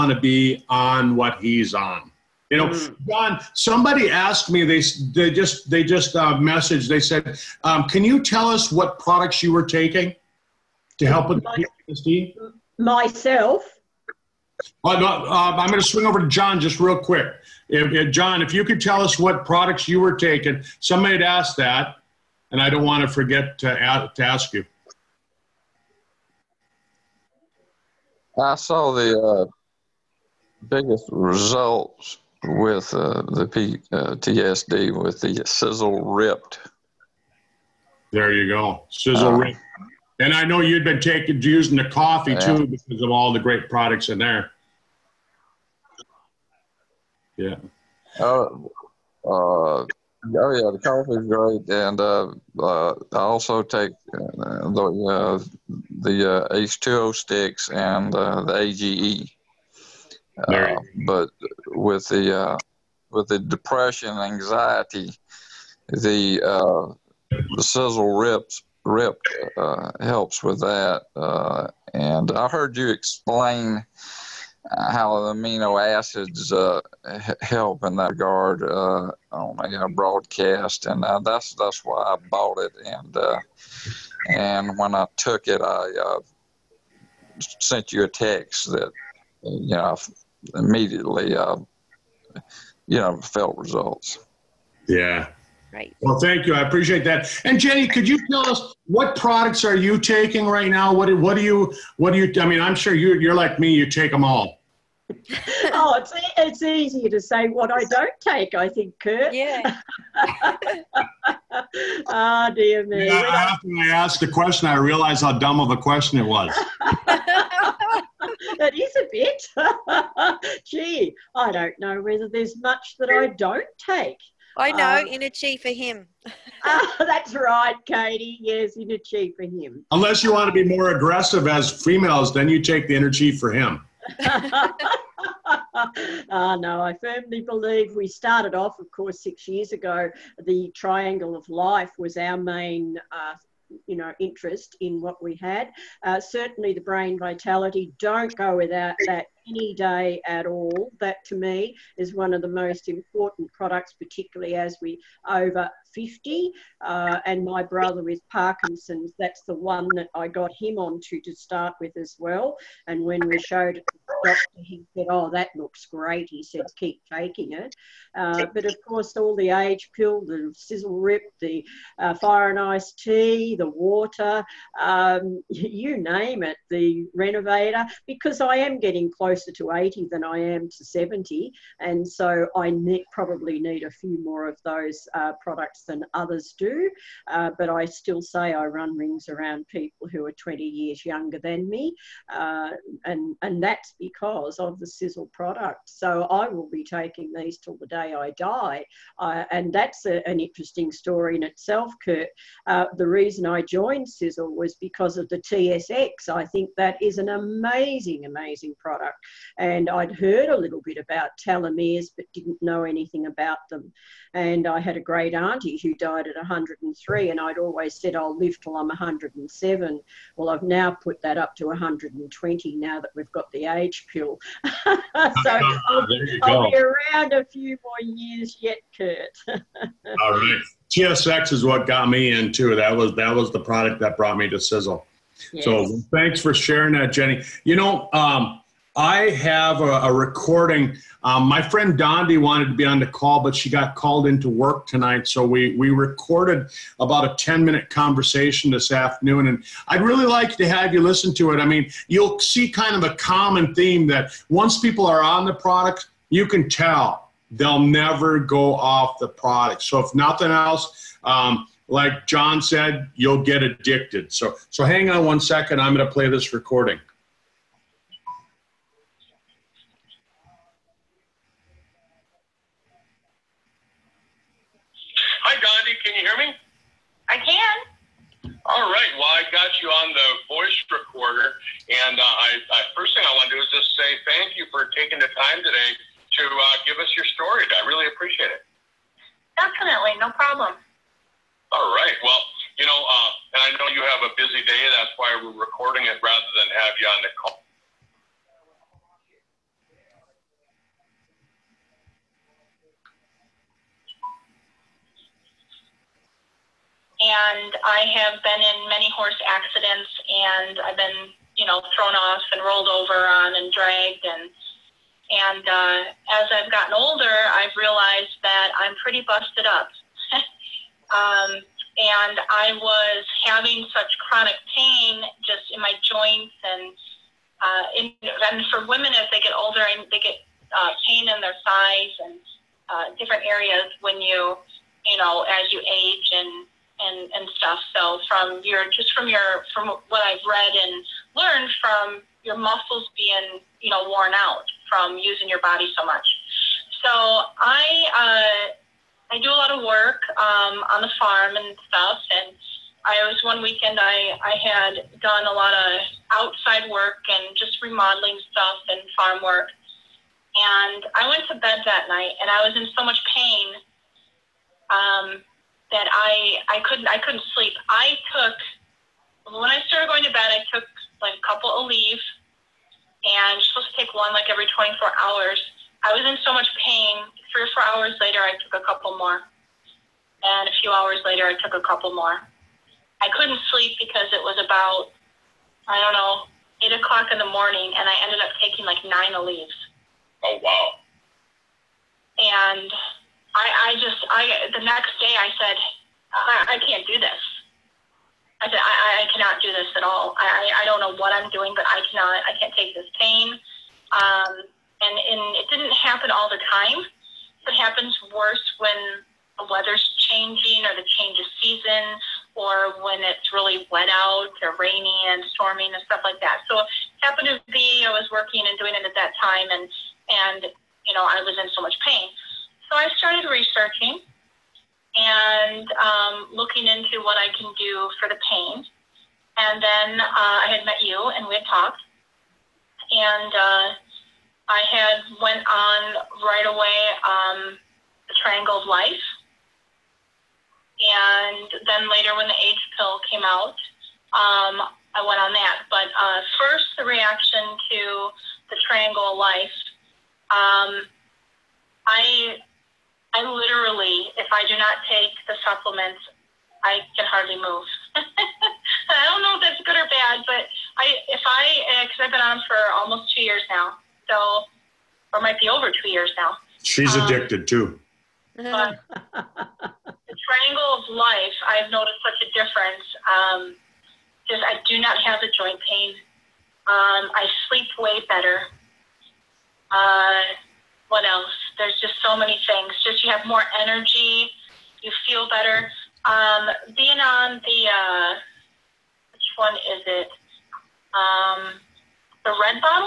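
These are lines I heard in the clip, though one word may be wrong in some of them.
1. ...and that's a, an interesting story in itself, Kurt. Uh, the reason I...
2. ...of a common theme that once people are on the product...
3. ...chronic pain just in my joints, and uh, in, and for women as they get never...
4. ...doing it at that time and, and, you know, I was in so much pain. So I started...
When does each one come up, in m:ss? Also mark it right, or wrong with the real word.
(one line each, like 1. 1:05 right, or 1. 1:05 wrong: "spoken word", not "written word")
1. 3:19 right
2. 4:12 right
3. 5:24 wrong: "older", not "never"
4. 6:58 right.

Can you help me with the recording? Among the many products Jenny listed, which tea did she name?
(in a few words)
Fire and Ice tea.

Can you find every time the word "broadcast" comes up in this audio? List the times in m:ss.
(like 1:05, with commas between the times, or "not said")
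1:19.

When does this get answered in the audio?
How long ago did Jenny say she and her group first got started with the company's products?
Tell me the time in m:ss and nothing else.
2:19.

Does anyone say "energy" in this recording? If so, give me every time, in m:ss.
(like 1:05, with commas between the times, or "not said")
2:12, 8:03.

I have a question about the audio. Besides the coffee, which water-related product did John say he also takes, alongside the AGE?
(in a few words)
H2O sticks.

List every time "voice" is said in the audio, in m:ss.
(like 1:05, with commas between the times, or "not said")
4:40.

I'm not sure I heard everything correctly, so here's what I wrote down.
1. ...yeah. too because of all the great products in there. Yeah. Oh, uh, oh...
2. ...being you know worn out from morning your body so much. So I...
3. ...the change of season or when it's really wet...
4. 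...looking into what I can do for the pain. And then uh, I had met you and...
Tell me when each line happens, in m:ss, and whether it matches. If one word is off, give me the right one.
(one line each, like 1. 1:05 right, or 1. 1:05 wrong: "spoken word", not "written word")
1. 0:42 right
2. 5:43 wrong: "using", not "morning"
3. 6:50 right
4. 7:06 right.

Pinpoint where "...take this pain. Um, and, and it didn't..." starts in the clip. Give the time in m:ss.
6:42.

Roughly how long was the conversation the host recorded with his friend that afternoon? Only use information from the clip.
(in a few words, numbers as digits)
10 minutes.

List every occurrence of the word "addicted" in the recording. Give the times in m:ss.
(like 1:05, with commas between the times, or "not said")
4:23, 7:47.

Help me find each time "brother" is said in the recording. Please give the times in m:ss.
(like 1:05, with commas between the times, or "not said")
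2:37.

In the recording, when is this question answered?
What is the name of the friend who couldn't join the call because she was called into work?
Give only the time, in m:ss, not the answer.
4:01.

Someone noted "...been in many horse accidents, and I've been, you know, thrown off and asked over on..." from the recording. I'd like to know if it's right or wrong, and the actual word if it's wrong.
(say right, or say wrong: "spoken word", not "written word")
wrong: "rolled", not "asked".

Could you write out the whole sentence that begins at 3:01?
And so I ne probably need a few more of those uh, products than others do.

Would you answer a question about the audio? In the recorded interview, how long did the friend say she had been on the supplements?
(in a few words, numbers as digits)
Almost 2 years.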